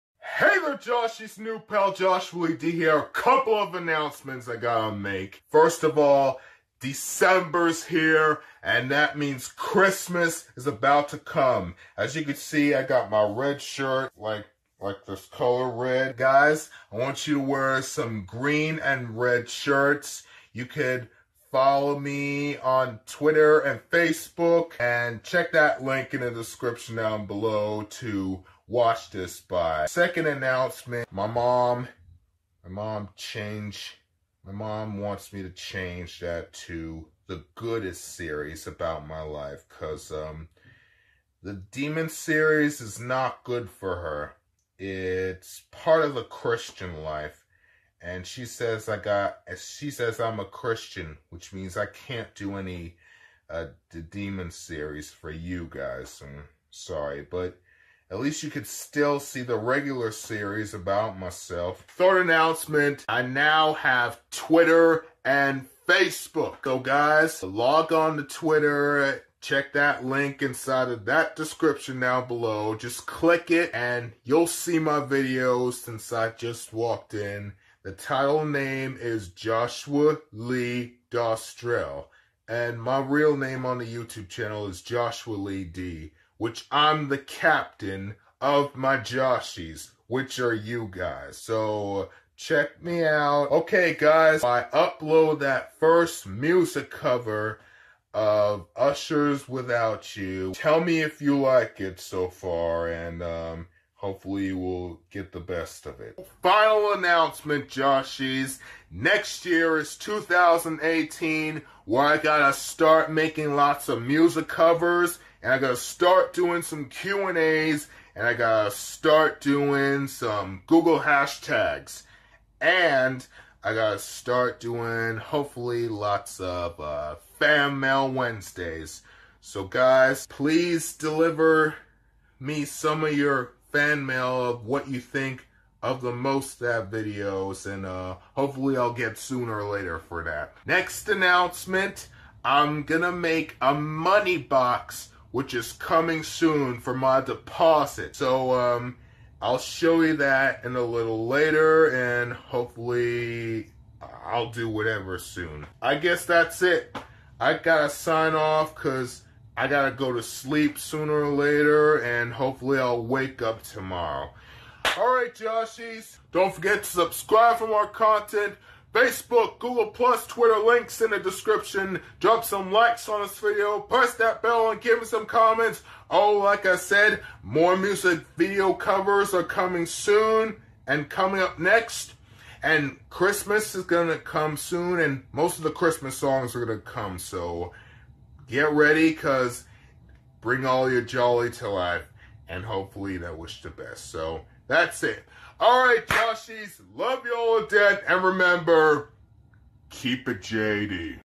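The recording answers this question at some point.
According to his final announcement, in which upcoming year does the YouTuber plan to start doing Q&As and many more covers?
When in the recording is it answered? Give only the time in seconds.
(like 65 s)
109 s.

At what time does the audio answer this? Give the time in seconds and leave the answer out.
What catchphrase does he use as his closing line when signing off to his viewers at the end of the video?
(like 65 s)
199 s.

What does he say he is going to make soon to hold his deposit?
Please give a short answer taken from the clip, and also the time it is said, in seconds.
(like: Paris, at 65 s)
A money box, at 143 s.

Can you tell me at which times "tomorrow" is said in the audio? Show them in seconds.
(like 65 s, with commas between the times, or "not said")
163 s.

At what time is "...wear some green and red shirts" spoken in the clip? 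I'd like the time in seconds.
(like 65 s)
17 s.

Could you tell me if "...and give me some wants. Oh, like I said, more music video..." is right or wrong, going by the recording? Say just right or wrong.
wrong.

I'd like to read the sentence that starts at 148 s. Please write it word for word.
So um, I'll show you that in a little later, and hopefully I'll do whatever soon.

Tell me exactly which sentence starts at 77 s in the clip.
The title name is Joshua Lee Dostrel.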